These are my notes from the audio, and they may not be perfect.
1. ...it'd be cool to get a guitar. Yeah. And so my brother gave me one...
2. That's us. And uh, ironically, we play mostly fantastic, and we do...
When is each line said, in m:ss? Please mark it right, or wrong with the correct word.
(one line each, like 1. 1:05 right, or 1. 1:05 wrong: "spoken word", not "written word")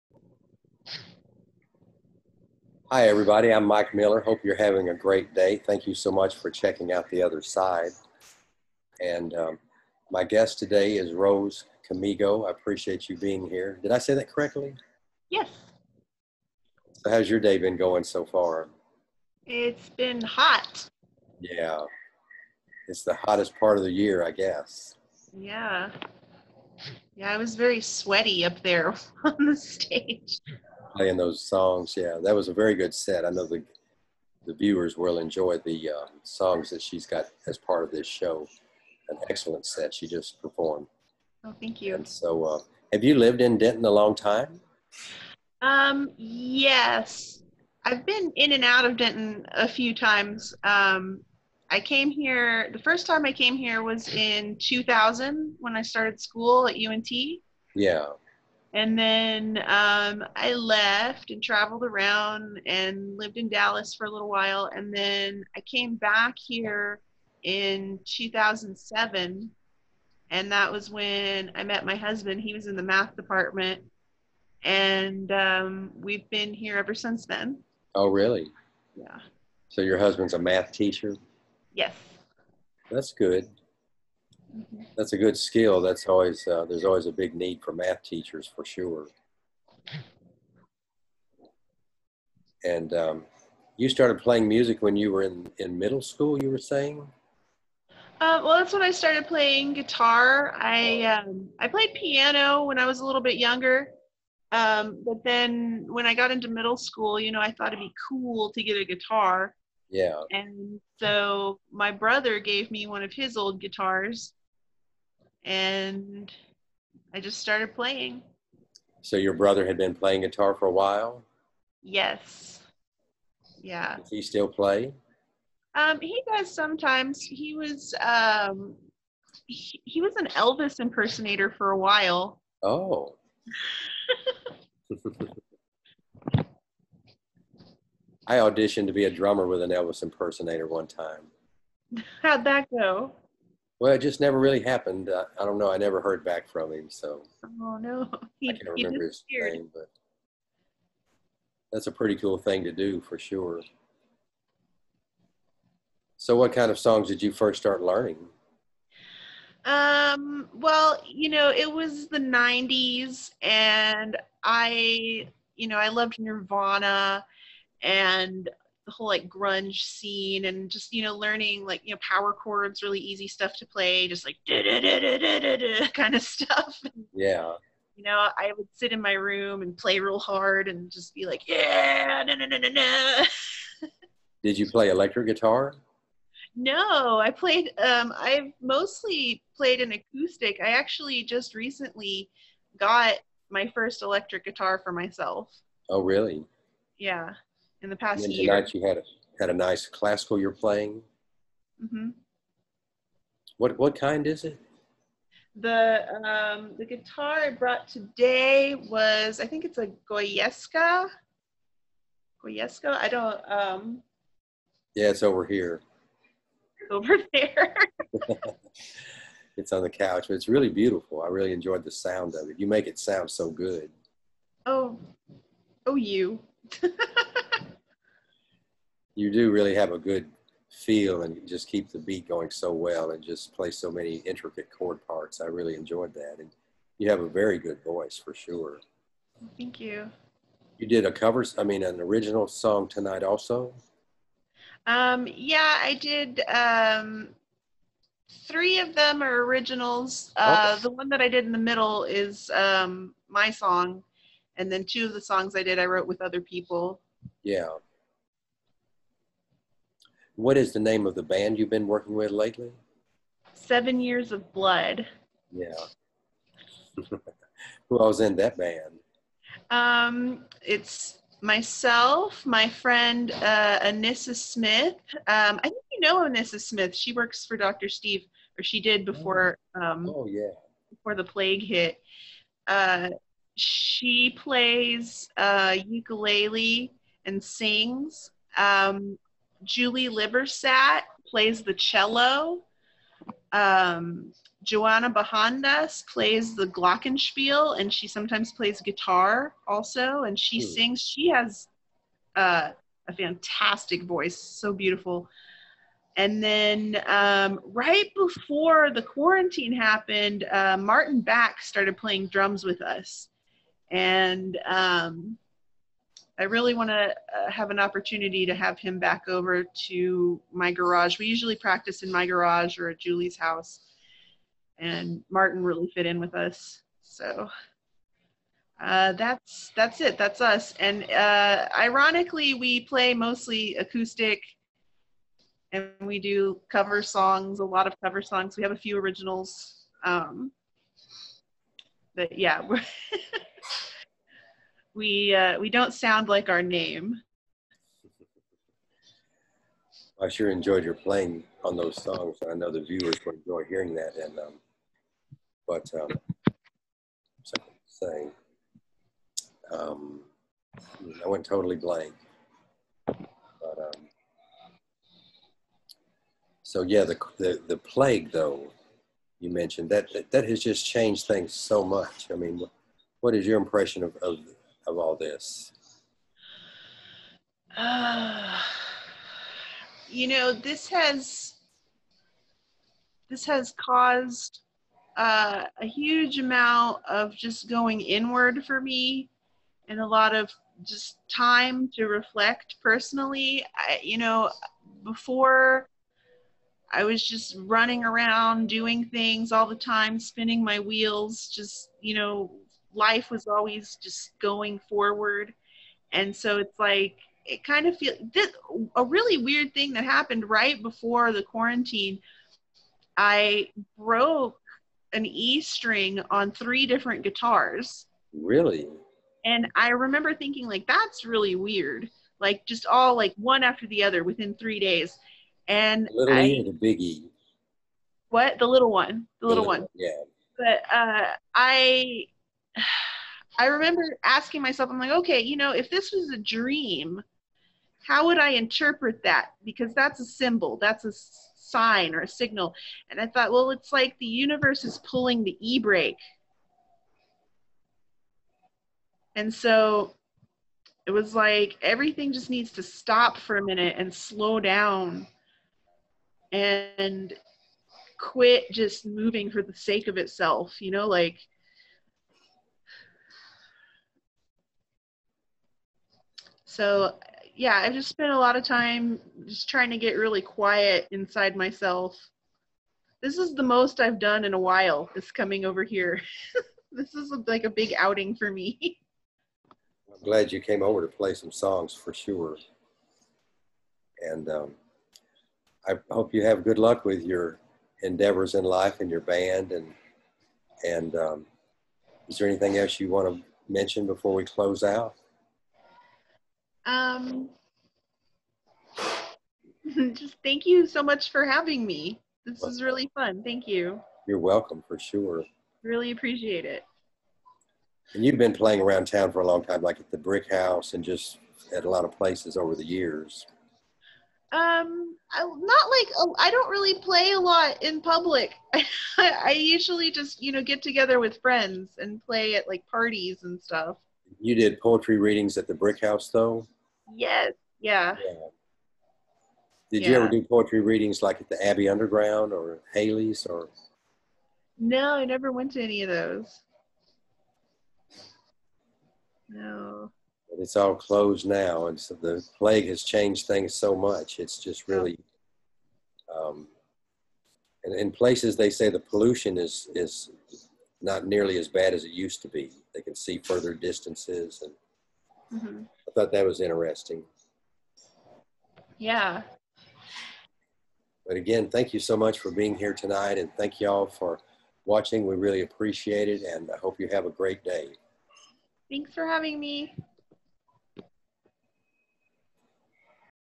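1. 1:47 right
2. 5:30 wrong: "acoustic", not "fantastic".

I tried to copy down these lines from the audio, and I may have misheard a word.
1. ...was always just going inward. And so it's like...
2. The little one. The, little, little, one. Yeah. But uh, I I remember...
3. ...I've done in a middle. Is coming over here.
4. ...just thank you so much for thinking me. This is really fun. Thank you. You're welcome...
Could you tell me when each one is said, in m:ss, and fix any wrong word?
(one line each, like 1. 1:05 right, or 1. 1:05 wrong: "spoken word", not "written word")
1. 6:43 wrong: "forward", not "inward"
2. 7:08 right
3. 7:53 wrong: "while", not "middle"
4. 8:20 wrong: "having", not "thinking".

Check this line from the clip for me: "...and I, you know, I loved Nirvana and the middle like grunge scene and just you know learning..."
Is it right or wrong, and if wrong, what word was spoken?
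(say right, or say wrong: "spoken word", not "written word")
wrong: "whole", not "middle".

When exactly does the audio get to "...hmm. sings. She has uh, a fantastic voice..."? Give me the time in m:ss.
5:00.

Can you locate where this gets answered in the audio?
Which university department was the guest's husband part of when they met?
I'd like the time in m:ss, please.
1:12.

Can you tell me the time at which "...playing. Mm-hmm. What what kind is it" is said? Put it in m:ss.
3:20.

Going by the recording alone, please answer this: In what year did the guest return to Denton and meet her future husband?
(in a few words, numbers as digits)
2007.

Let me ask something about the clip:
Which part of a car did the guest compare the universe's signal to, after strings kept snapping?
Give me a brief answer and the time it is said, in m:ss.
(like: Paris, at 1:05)
the e brake, at 7:25.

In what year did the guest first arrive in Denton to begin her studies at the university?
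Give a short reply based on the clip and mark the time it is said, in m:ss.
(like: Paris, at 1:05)
2000, at 0:54.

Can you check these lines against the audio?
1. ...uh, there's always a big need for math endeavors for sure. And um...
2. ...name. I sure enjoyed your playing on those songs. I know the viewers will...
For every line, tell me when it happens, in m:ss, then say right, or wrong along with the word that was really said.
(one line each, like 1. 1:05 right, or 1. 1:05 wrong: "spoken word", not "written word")
1. 1:26 wrong: "teachers", not "endeavors"
2. 5:46 right.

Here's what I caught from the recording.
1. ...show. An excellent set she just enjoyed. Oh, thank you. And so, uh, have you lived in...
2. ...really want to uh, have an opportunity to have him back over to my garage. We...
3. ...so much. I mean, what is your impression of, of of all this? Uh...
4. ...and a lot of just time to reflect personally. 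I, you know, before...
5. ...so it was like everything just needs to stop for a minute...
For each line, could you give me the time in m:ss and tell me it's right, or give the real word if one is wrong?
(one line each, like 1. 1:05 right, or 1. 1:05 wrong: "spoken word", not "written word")
1. 0:38 wrong: "performed", not "enjoyed"
2. 5:16 right
3. 6:11 right
4. 6:29 right
5. 7:29 right.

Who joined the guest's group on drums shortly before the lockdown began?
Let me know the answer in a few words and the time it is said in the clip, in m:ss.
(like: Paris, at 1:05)
Martin Back, at 5:10.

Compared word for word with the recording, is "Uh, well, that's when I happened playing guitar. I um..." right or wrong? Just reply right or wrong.
wrong.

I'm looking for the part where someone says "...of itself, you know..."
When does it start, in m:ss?
7:40.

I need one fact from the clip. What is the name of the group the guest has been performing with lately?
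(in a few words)
Seven Years of Blood.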